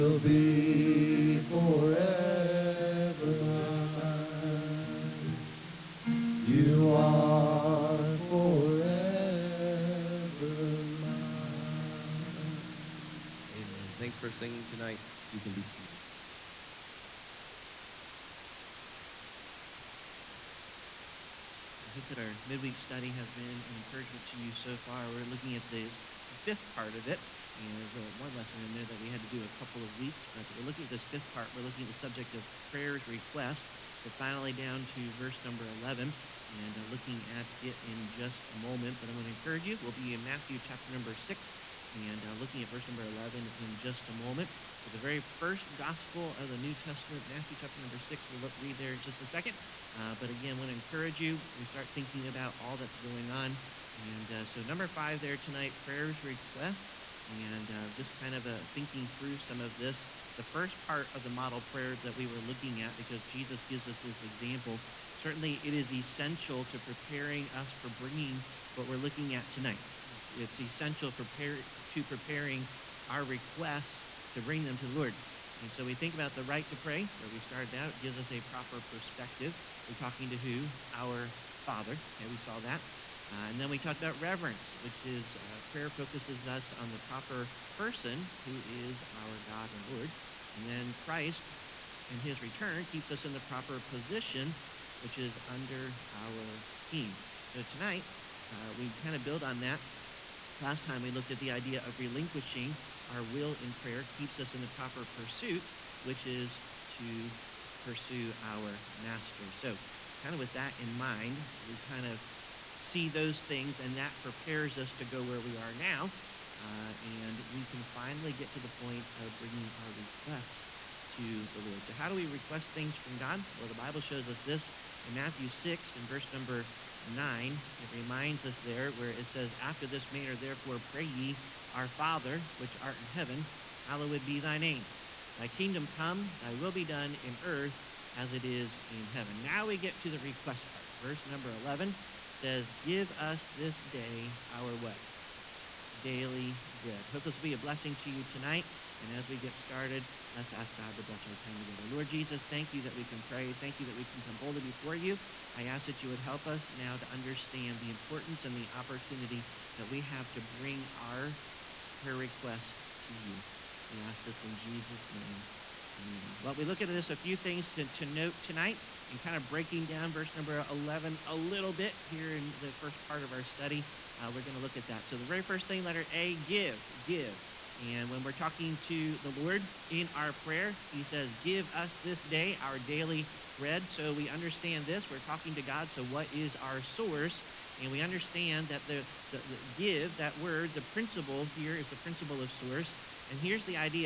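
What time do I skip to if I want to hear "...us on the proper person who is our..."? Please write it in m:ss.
1:26.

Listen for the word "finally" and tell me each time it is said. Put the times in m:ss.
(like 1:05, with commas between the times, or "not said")
0:34, 1:57.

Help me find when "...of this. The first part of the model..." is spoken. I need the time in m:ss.
0:59.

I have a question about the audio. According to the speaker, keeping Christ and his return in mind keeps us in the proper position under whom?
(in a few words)
our King.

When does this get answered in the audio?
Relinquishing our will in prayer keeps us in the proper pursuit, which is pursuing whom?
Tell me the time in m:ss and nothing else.
1:48.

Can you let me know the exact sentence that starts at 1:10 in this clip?
It's, essential for to preparing our requests to bring them to the Lord.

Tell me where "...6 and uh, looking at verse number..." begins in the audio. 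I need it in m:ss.
0:41.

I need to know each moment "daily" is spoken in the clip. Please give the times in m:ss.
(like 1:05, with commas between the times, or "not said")
2:26, 3:02.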